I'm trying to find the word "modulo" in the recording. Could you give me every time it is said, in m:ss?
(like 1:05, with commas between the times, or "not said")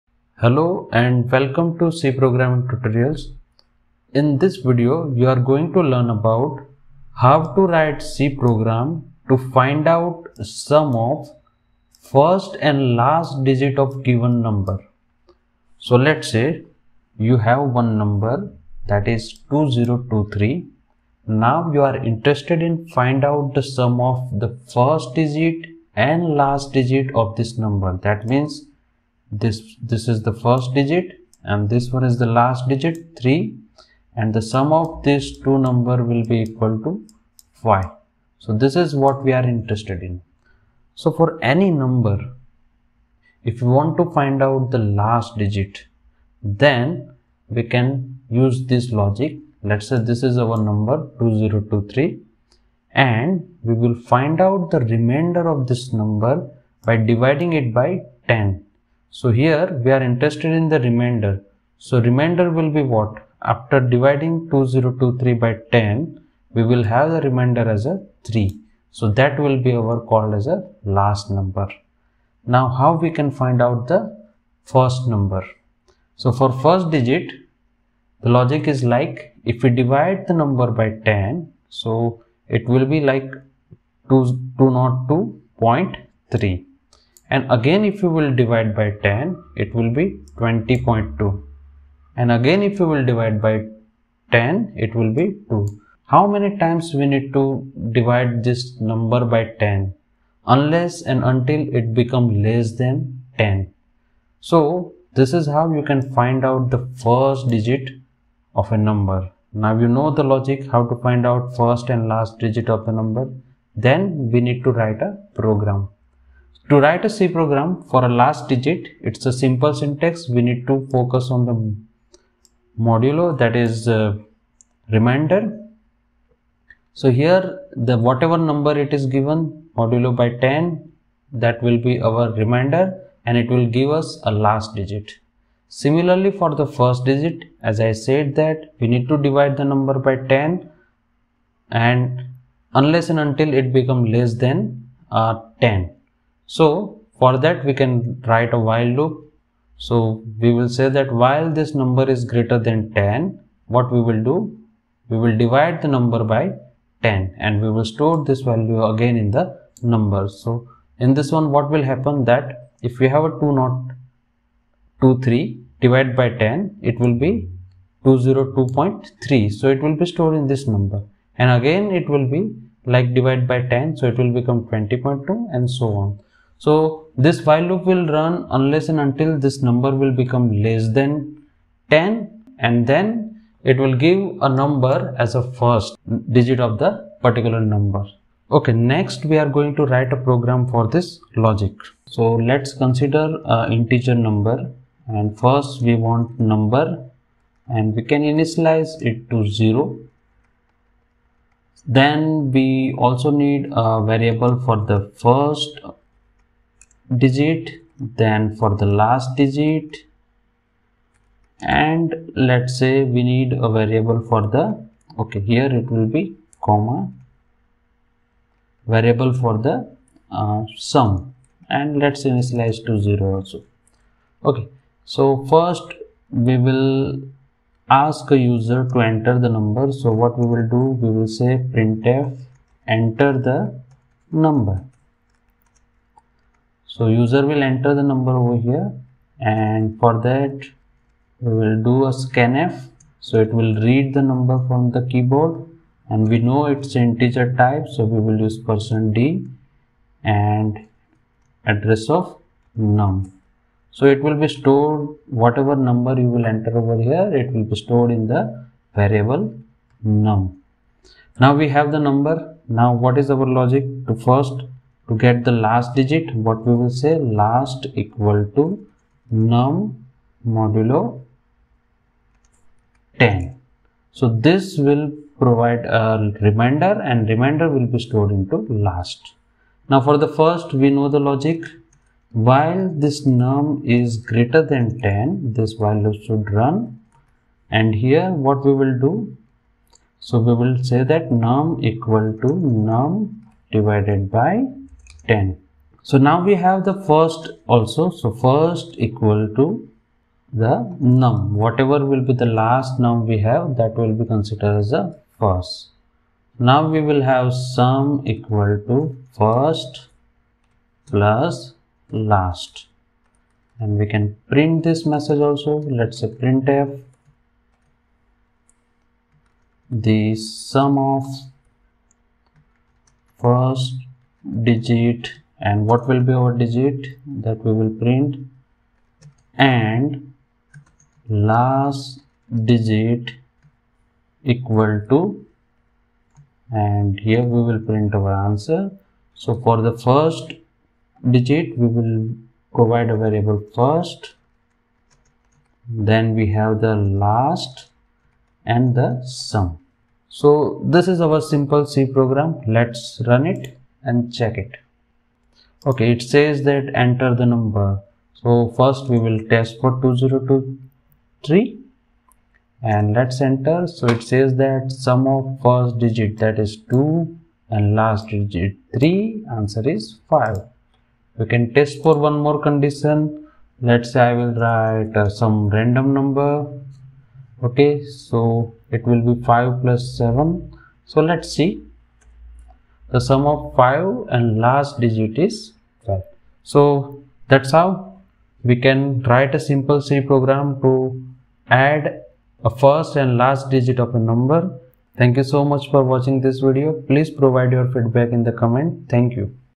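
2:02, 2:09, 4:30.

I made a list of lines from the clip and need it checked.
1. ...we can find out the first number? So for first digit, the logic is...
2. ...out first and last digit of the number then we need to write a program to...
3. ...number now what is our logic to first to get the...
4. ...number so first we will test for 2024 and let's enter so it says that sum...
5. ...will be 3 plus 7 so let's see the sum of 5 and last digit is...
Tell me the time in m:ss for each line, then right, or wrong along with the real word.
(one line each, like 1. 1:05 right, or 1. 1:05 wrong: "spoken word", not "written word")
1. 1:12 right
2. 1:51 right
3. 4:22 right
4. 5:57 wrong: "2023", not "2024"
5. 6:19 wrong: "5", not "3".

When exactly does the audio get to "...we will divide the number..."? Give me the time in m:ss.
2:35.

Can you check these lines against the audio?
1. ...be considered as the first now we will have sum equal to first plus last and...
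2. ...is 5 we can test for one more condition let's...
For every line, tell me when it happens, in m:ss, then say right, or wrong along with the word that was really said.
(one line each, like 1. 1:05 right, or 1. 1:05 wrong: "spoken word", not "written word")
1. 5:04 right
2. 6:09 right.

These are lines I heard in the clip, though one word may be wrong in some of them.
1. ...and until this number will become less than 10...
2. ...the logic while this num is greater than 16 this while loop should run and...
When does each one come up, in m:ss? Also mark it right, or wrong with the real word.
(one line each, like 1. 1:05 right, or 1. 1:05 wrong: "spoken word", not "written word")
1. 2:58 right
2. 4:41 wrong: "10", not "16".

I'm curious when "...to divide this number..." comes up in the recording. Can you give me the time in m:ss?
1:37.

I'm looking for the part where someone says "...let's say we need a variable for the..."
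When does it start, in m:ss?
3:32.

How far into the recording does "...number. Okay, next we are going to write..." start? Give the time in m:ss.
3:07.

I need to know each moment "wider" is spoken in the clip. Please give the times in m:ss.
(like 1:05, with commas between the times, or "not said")
not said.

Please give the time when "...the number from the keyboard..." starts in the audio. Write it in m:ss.
4:04.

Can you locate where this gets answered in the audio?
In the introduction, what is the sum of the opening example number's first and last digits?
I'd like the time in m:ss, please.
0:36.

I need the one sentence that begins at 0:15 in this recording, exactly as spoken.
So let's say you have one number that is 2023.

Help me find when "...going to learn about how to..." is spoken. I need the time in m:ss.
0:05.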